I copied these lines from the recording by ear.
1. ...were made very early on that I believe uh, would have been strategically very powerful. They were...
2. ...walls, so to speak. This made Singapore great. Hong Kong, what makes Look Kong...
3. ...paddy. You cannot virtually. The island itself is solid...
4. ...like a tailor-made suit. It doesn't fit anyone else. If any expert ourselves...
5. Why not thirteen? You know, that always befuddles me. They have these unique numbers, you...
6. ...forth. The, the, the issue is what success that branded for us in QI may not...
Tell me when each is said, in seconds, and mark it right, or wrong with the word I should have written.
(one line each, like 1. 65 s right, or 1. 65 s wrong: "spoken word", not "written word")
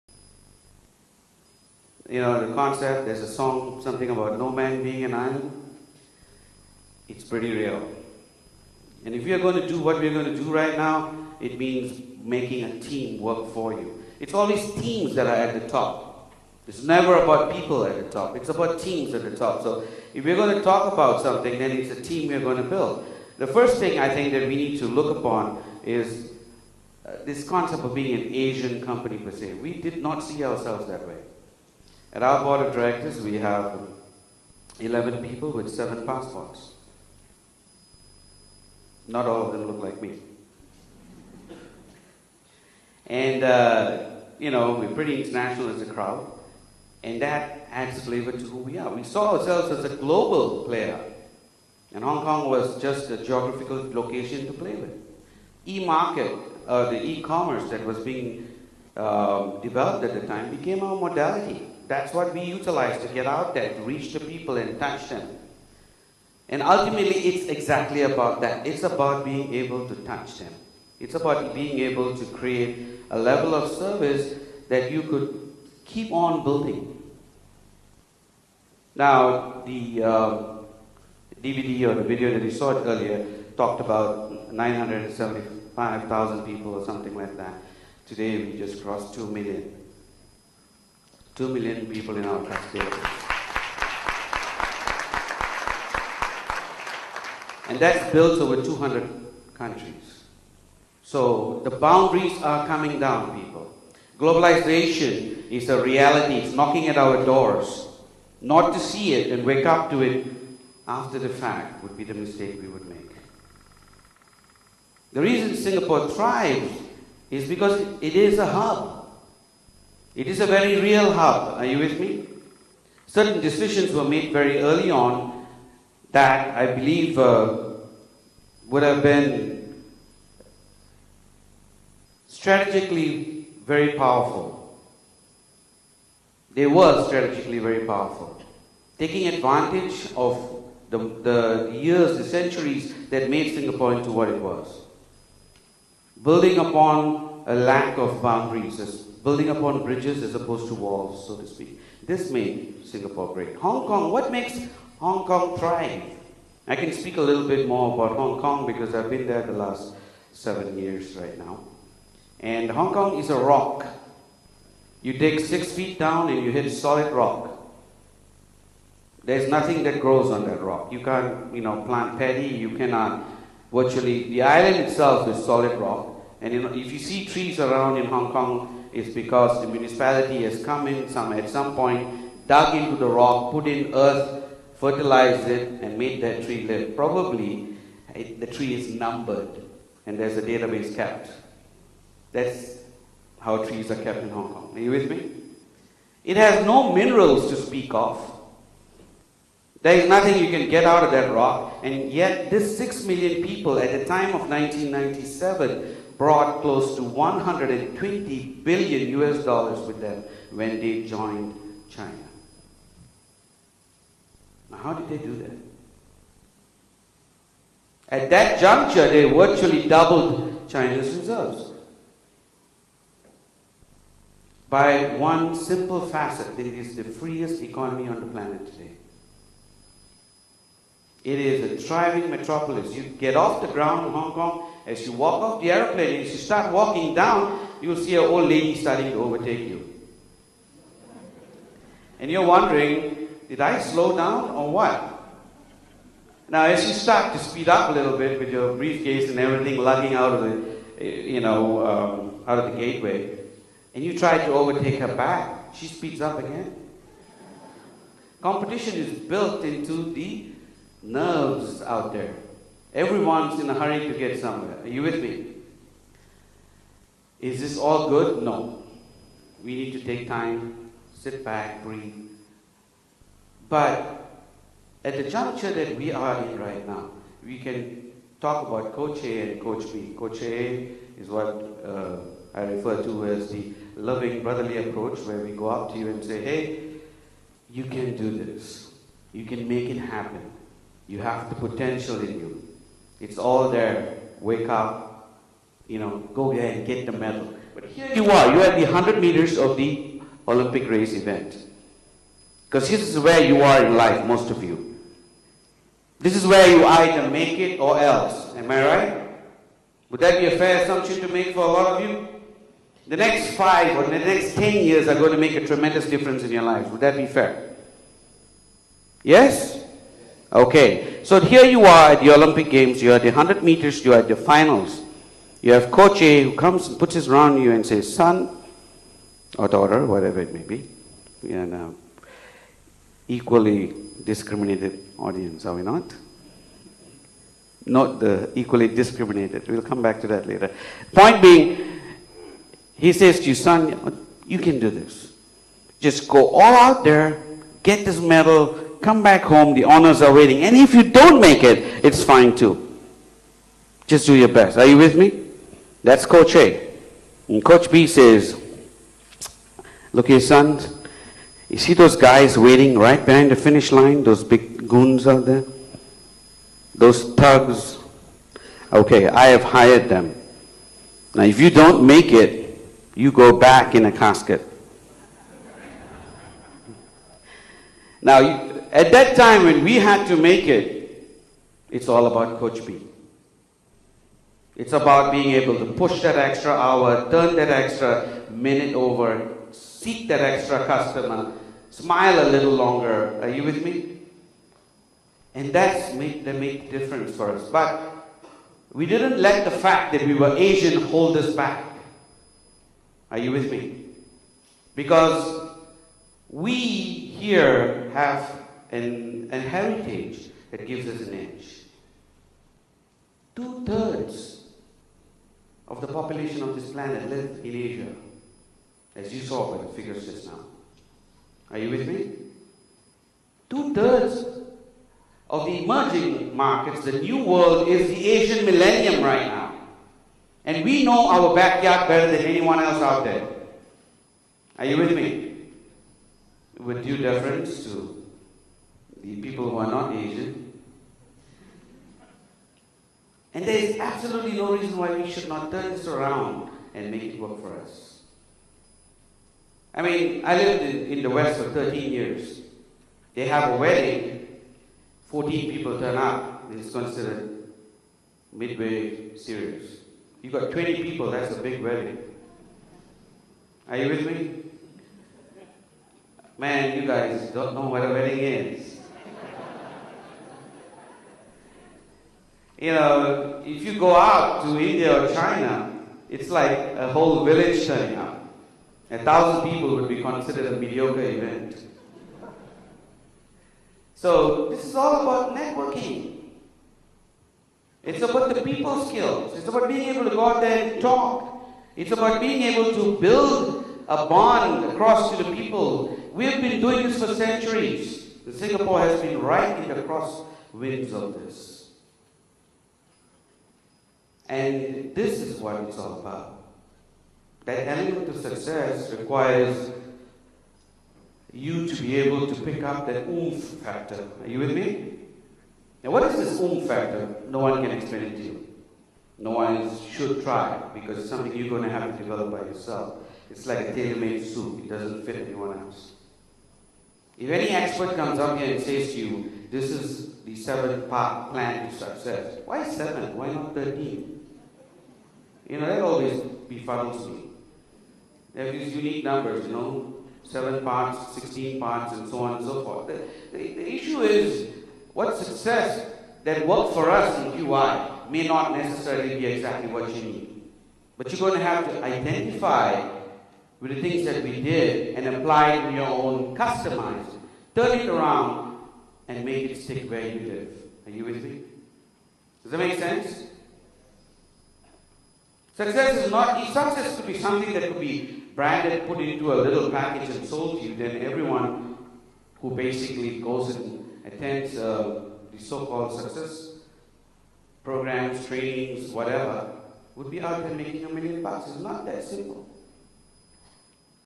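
1. 123 s right
2. 150 s wrong: "Hong", not "Look"
3. 172 s right
4. 523 s wrong: "comes", not "ourselves"
5. 533 s right
6. 542 s wrong: "worked", not "branded".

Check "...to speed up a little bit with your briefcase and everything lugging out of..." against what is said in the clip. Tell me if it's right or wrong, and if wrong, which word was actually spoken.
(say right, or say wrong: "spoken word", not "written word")
right.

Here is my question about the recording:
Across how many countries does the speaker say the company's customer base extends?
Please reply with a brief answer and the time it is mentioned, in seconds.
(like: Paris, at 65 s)
over 200, at 98 s.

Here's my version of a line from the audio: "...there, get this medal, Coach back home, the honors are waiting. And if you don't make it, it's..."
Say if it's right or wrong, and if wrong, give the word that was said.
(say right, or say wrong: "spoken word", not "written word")
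wrong: "Come", not "Coach".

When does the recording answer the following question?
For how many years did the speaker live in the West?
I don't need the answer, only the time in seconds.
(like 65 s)
451 s.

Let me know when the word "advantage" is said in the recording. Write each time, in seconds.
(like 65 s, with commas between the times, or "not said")
139 s.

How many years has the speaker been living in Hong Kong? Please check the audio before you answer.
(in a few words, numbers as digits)
7.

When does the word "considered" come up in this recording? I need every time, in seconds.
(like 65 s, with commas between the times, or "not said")
456 s, 480 s.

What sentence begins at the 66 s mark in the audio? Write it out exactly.
And ultimately, it's exactly about that.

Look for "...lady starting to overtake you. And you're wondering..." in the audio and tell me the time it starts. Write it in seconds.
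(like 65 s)
238 s.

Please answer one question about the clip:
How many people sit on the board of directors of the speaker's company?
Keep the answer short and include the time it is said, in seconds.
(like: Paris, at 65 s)
11, at 34 s.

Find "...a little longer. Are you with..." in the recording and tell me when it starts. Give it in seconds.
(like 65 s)
392 s.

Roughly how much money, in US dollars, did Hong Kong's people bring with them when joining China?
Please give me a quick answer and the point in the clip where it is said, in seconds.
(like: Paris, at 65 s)
120 billion US dollars, at 207 s.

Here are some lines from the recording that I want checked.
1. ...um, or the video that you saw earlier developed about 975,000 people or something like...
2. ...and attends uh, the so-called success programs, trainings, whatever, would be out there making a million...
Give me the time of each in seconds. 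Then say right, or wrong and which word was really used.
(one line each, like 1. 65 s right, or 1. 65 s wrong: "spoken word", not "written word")
1. 80 s wrong: "talked", not "developed"
2. 573 s right.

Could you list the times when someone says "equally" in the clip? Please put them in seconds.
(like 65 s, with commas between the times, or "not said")
333 s, 338 s.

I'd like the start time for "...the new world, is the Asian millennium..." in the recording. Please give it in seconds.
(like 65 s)
427 s.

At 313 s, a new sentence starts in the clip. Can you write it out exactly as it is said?
The next five or the next 10 years are going to make a tremendous difference in your life.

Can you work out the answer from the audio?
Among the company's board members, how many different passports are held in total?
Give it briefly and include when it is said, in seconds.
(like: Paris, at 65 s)
7, at 35 s.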